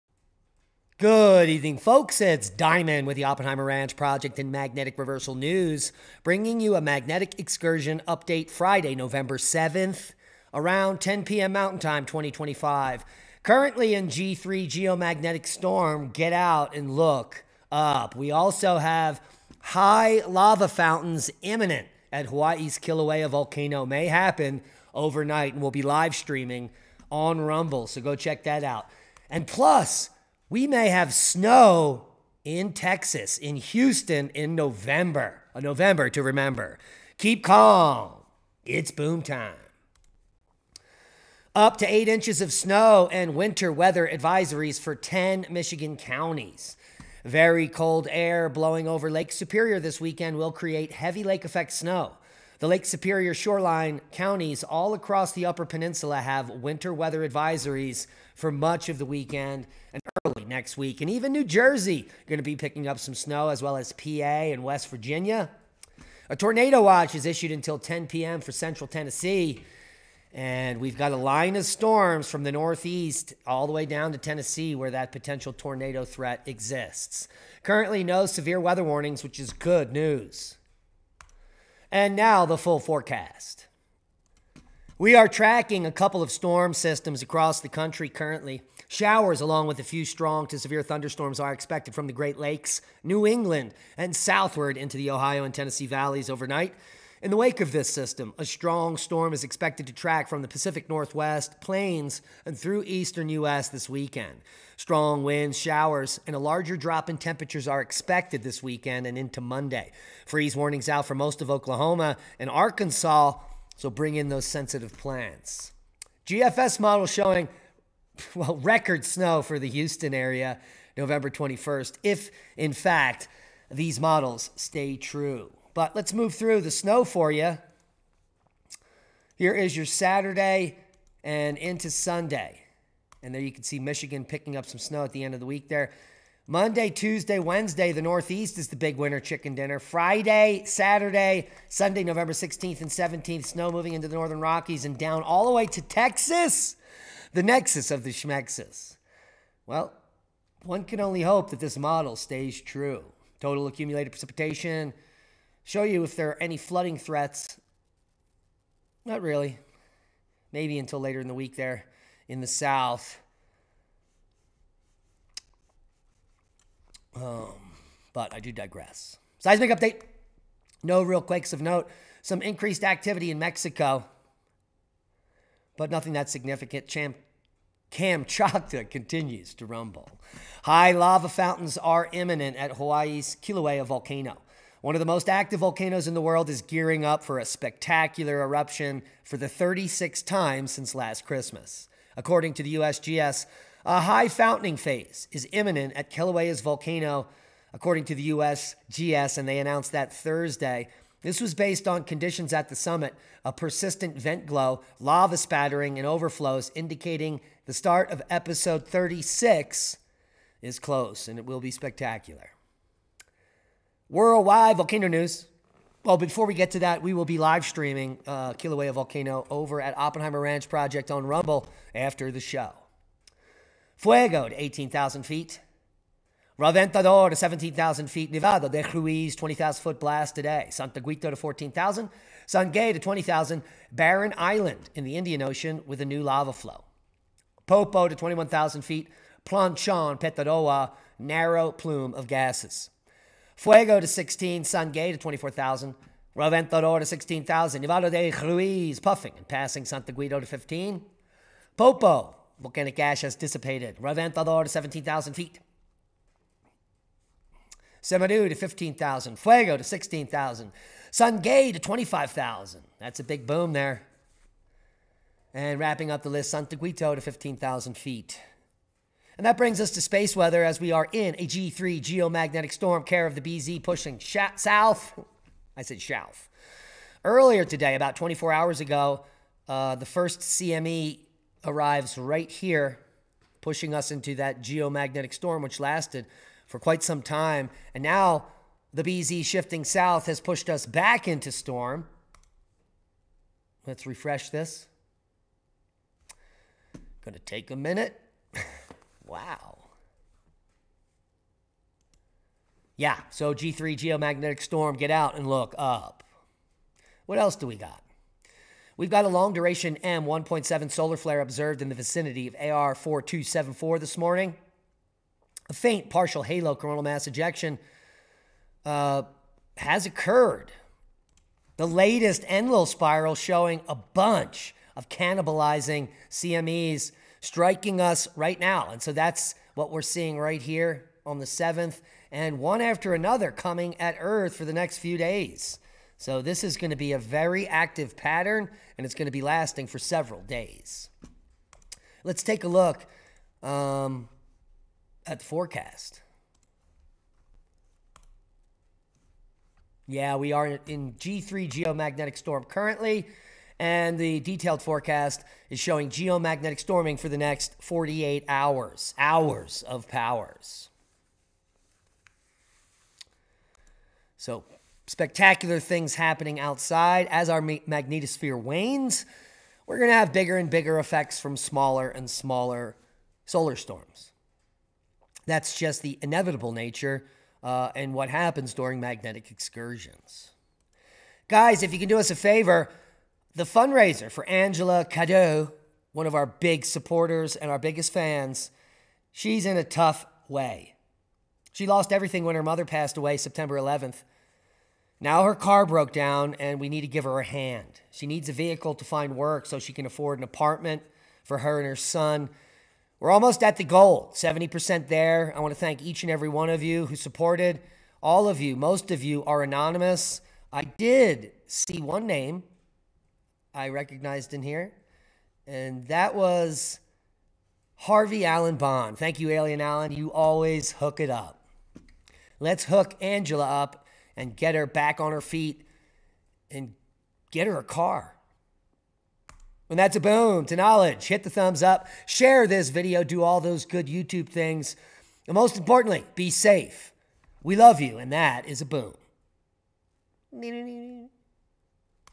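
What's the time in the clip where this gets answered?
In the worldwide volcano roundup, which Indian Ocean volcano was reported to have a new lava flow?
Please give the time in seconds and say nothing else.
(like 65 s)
233 s.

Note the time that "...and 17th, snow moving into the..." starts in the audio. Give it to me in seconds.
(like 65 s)
142 s.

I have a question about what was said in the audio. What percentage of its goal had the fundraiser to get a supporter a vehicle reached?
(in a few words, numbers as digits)
70%.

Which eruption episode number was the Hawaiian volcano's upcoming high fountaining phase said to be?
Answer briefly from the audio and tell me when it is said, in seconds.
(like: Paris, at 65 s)
36, at 208 s.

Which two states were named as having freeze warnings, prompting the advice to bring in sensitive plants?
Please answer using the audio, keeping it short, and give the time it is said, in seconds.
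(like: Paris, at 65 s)
Oklahoma and Arkansas, at 111 s.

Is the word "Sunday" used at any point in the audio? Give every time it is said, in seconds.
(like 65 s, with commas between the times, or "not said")
131 s, 141 s.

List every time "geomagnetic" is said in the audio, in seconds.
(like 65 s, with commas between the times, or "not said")
14 s, 272 s, 284 s, 303 s, 351 s, 356 s.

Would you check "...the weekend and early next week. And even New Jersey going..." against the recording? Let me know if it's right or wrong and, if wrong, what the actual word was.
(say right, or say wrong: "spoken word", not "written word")
right.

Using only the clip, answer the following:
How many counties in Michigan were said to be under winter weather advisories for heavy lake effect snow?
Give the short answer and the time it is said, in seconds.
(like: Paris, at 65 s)
10, at 44 s.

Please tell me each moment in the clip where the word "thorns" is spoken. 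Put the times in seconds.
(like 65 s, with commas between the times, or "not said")
not said.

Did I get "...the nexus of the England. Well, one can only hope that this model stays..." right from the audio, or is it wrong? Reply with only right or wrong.
wrong.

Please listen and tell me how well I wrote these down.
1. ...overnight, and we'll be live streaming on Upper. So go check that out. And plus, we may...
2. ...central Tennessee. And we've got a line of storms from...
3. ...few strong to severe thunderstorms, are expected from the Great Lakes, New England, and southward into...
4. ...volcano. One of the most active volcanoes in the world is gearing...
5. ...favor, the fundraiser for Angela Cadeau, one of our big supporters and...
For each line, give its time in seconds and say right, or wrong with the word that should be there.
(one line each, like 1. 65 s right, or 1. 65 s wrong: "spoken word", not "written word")
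1. 24 s wrong: "Rumble", not "Upper"
2. 68 s right
3. 89 s right
4. 183 s right
5. 382 s right.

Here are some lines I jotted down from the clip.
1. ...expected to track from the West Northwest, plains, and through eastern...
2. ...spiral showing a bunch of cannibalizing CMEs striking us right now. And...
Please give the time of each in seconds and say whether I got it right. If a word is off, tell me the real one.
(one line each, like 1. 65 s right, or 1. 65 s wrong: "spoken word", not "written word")
1. 99 s wrong: "Pacific", not "West"
2. 322 s right.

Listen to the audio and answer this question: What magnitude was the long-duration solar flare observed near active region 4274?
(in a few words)
M1.7.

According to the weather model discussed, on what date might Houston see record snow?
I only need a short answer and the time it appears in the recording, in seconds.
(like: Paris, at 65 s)
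November 21st, at 120 s.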